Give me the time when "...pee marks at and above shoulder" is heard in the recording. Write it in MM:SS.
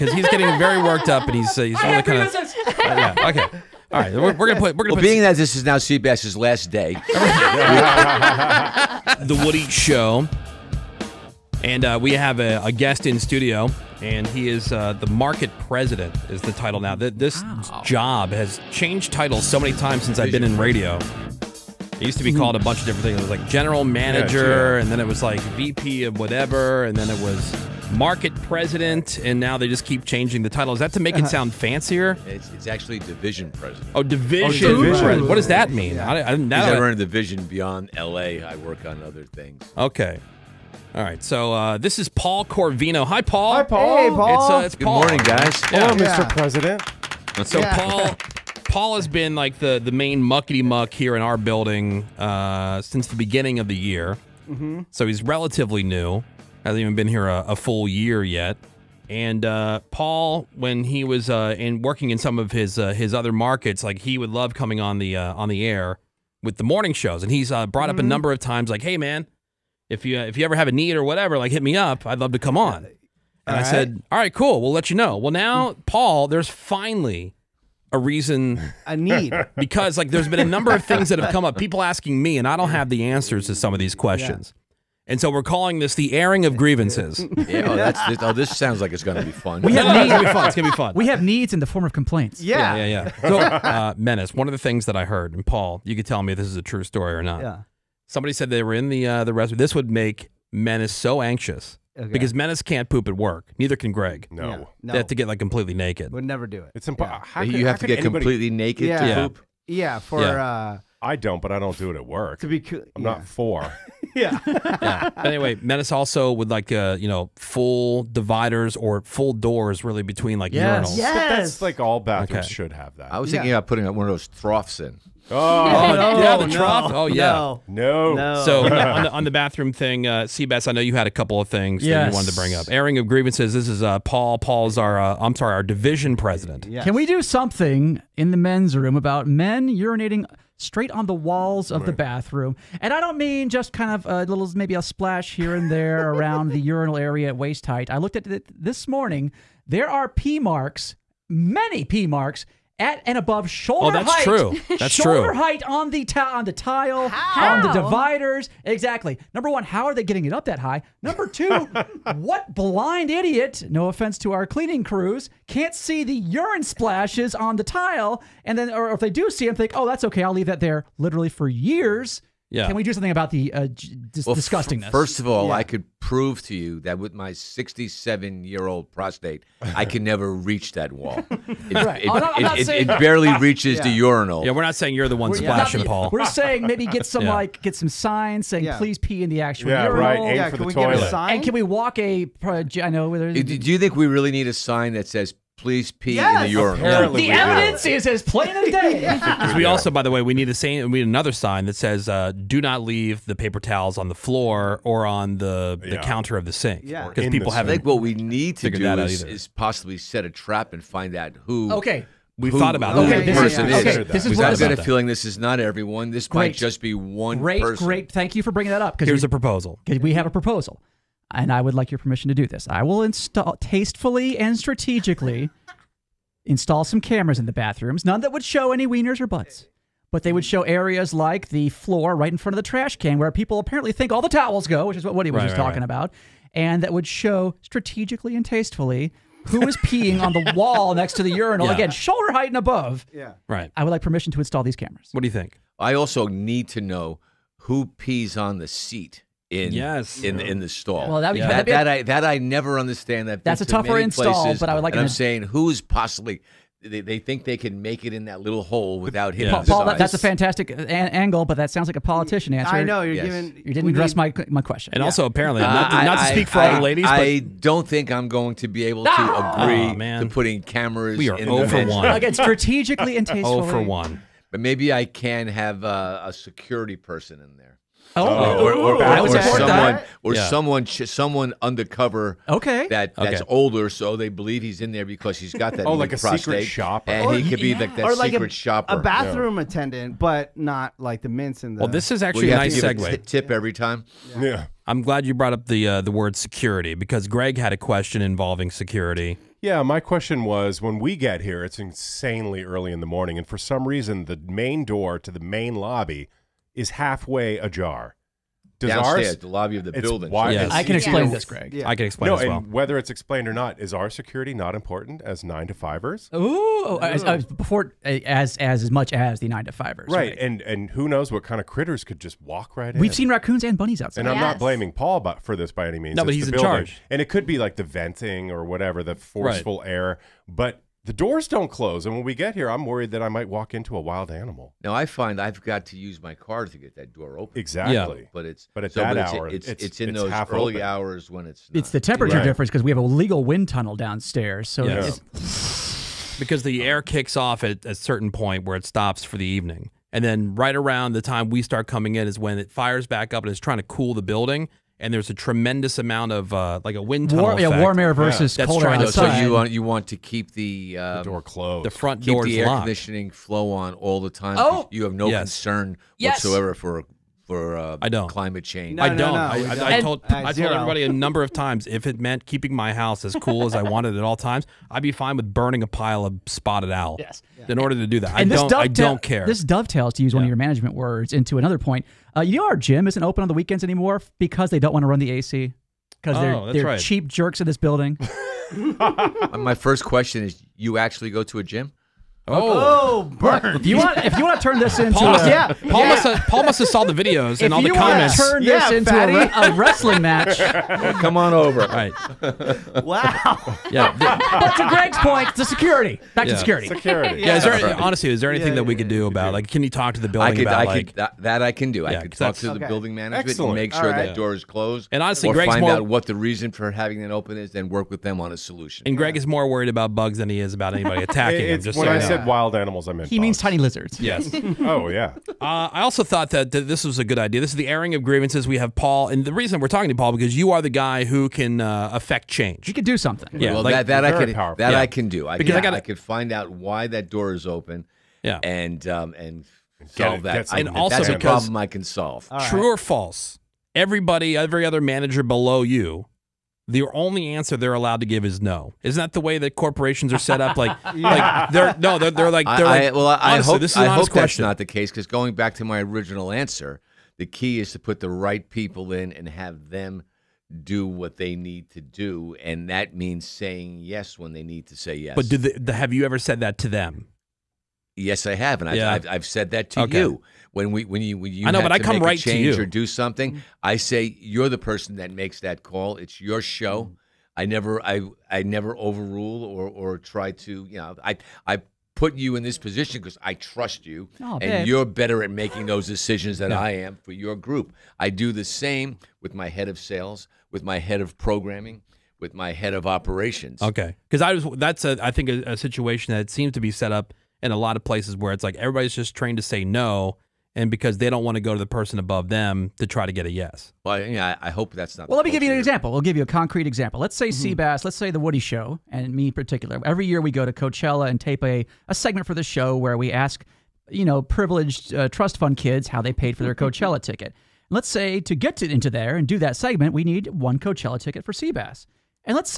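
02:31.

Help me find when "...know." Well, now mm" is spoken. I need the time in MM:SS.
01:14.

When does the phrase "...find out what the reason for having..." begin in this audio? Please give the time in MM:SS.
06:55.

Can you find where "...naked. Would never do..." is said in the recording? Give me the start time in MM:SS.
01:45.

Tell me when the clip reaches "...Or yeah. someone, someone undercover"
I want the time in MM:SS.
04:40.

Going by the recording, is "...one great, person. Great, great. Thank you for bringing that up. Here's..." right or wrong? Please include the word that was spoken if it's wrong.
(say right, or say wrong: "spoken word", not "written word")
right.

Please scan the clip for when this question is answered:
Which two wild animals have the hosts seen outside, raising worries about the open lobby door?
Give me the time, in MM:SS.
05:23.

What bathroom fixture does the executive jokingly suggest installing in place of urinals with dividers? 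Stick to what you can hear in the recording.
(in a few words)
Troughs.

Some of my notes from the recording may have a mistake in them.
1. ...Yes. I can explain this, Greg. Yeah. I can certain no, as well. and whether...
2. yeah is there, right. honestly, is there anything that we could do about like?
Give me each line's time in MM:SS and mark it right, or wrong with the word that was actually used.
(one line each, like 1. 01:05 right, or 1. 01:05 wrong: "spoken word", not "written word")
1. 05:10 wrong: "explain", not "certain"
2. 06:47 right.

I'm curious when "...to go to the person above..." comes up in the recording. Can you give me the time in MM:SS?
08:21.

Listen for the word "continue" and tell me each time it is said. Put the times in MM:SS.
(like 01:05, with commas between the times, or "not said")
not said.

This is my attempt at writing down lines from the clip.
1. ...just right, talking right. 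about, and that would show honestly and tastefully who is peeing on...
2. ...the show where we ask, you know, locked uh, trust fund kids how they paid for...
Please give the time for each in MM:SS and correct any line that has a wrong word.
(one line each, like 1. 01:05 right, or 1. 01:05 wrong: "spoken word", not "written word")
1. 03:55 wrong: "strategically", not "honestly"
2. 08:32 wrong: "privileged", not "locked".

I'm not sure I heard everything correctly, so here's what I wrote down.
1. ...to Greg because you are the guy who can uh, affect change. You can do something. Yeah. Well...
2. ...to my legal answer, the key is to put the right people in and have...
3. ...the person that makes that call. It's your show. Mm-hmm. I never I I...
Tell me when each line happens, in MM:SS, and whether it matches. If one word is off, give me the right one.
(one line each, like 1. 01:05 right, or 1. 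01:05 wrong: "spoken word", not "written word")
1. 07:10 wrong: "Paul", not "Greg"
2. 07:35 wrong: "original", not "legal"
3. 07:54 right.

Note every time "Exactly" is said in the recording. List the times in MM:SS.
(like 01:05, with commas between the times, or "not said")
02:38, 05:37.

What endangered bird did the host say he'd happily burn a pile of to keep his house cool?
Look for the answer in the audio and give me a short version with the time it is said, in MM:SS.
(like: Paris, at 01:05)
Spotted owl, at 06:16.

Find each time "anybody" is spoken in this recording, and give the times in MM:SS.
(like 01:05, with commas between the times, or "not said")
01:48, 07:00.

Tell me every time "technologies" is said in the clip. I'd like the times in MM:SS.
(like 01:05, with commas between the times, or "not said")
not said.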